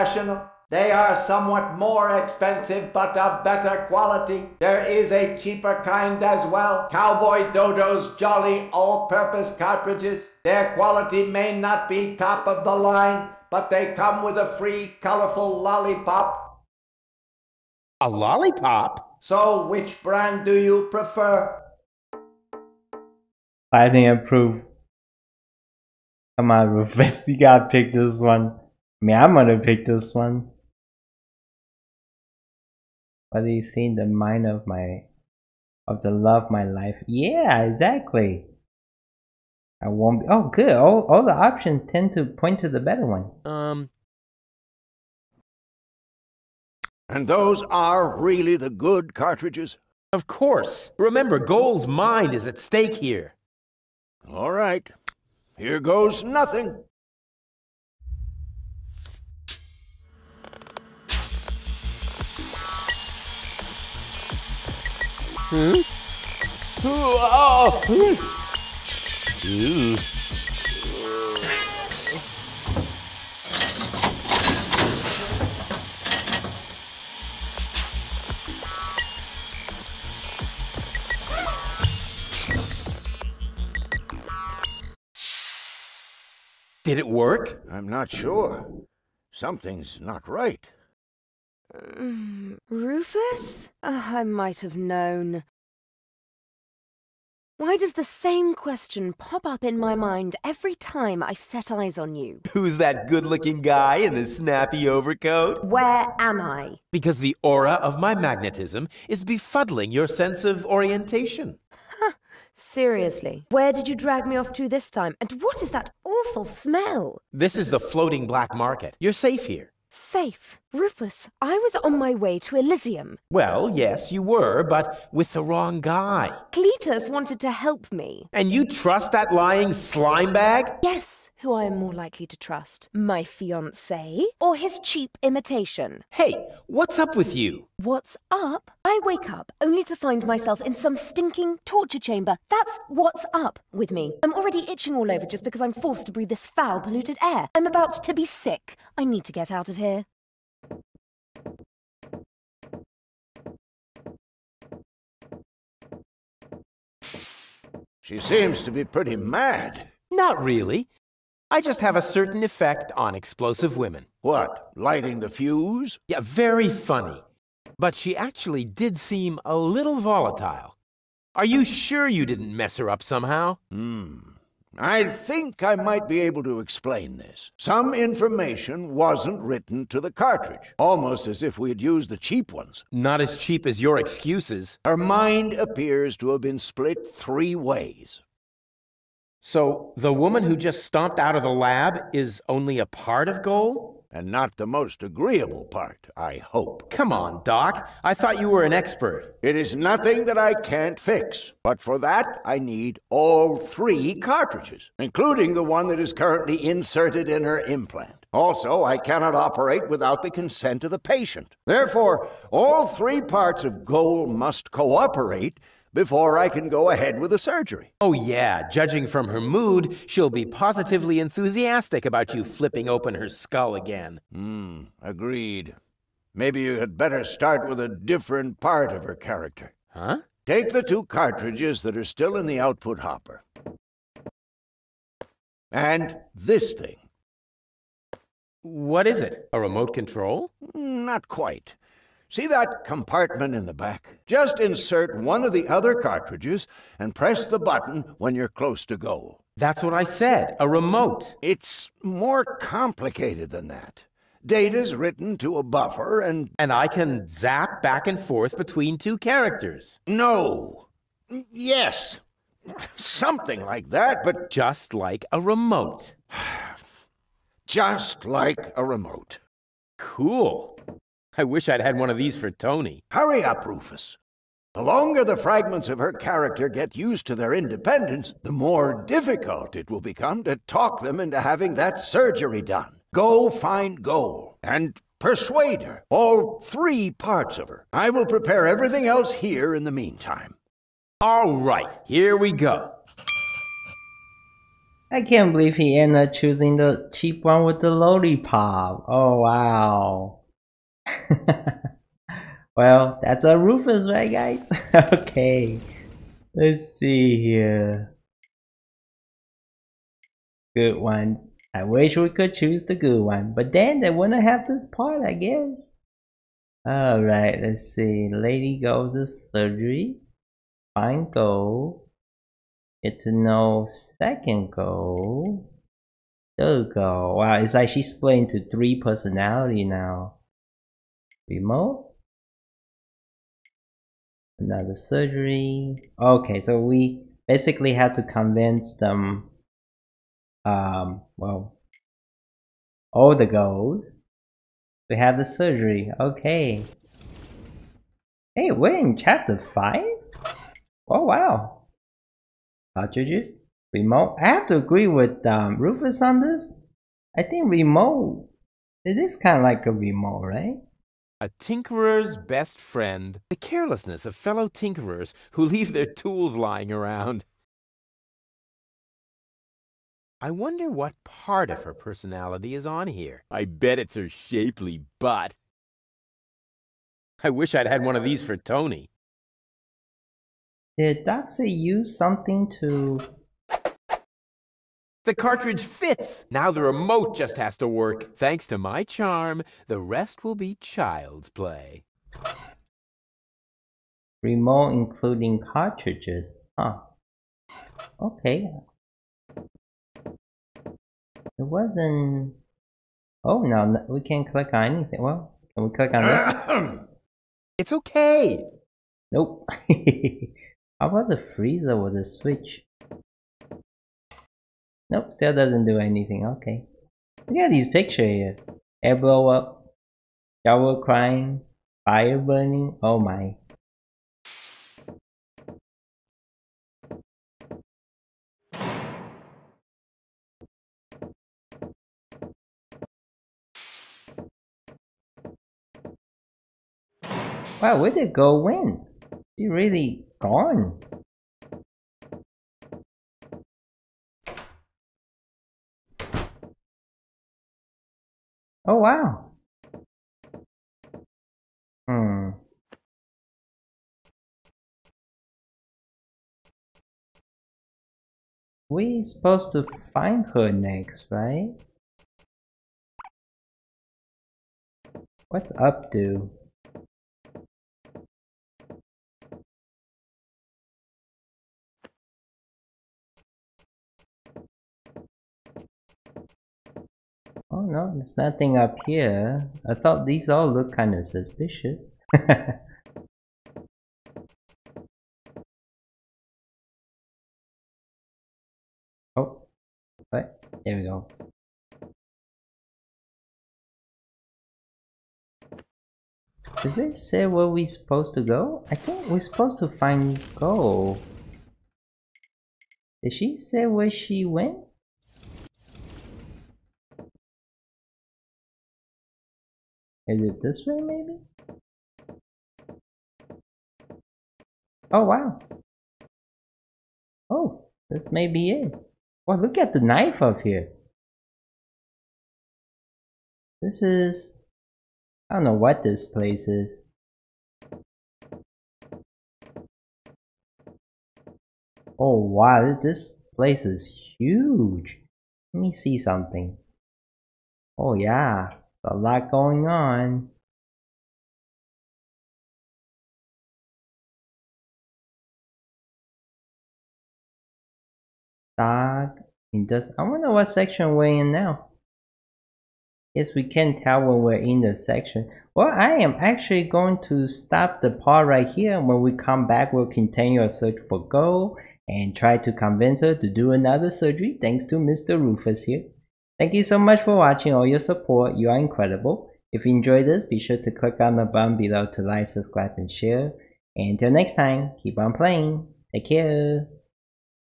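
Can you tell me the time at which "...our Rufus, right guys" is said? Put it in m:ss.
5:03.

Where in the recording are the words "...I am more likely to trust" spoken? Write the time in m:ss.
2:11.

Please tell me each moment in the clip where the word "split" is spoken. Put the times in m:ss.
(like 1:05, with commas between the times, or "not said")
3:06, 5:28.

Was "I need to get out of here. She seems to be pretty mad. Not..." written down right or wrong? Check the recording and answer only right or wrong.
right.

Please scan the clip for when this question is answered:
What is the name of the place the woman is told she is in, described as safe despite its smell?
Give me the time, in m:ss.
1:57.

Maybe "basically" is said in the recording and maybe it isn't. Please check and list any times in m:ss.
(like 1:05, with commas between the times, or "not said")
5:37.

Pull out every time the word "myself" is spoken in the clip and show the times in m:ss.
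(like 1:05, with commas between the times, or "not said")
2:20.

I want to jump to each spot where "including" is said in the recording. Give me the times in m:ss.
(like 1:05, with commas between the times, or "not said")
3:24, 6:34.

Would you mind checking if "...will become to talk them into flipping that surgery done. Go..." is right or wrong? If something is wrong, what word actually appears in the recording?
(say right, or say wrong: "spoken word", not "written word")
wrong: "having", not "flipping".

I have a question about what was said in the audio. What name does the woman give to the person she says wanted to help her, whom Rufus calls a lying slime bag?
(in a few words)
Cletus.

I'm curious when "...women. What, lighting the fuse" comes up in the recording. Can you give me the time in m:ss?
2:43.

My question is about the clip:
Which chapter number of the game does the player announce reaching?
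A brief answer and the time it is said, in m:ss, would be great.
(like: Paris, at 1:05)
5, at 5:49.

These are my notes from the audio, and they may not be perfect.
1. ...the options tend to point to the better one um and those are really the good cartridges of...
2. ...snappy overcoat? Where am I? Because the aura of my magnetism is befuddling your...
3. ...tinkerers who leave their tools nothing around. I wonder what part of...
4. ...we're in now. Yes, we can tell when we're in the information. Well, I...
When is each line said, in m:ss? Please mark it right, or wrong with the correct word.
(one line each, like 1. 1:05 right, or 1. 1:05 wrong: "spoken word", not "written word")
1. 0:41 right
2. 1:44 right
3. 6:04 wrong: "lying", not "nothing"
4. 9:11 wrong: "section", not "information".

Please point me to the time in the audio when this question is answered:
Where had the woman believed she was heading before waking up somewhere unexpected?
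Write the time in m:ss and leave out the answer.
2:02.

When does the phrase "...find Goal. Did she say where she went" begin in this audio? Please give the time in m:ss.
8:19.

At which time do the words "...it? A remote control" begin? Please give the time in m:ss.
3:59.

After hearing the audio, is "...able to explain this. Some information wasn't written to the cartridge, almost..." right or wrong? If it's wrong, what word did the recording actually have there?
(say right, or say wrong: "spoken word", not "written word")
right.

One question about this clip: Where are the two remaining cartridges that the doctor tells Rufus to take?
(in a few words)
output hopper.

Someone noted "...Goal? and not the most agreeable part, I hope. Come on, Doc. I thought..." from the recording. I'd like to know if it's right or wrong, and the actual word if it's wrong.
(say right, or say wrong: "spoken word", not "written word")
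right.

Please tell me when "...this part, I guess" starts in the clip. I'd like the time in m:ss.
5:14.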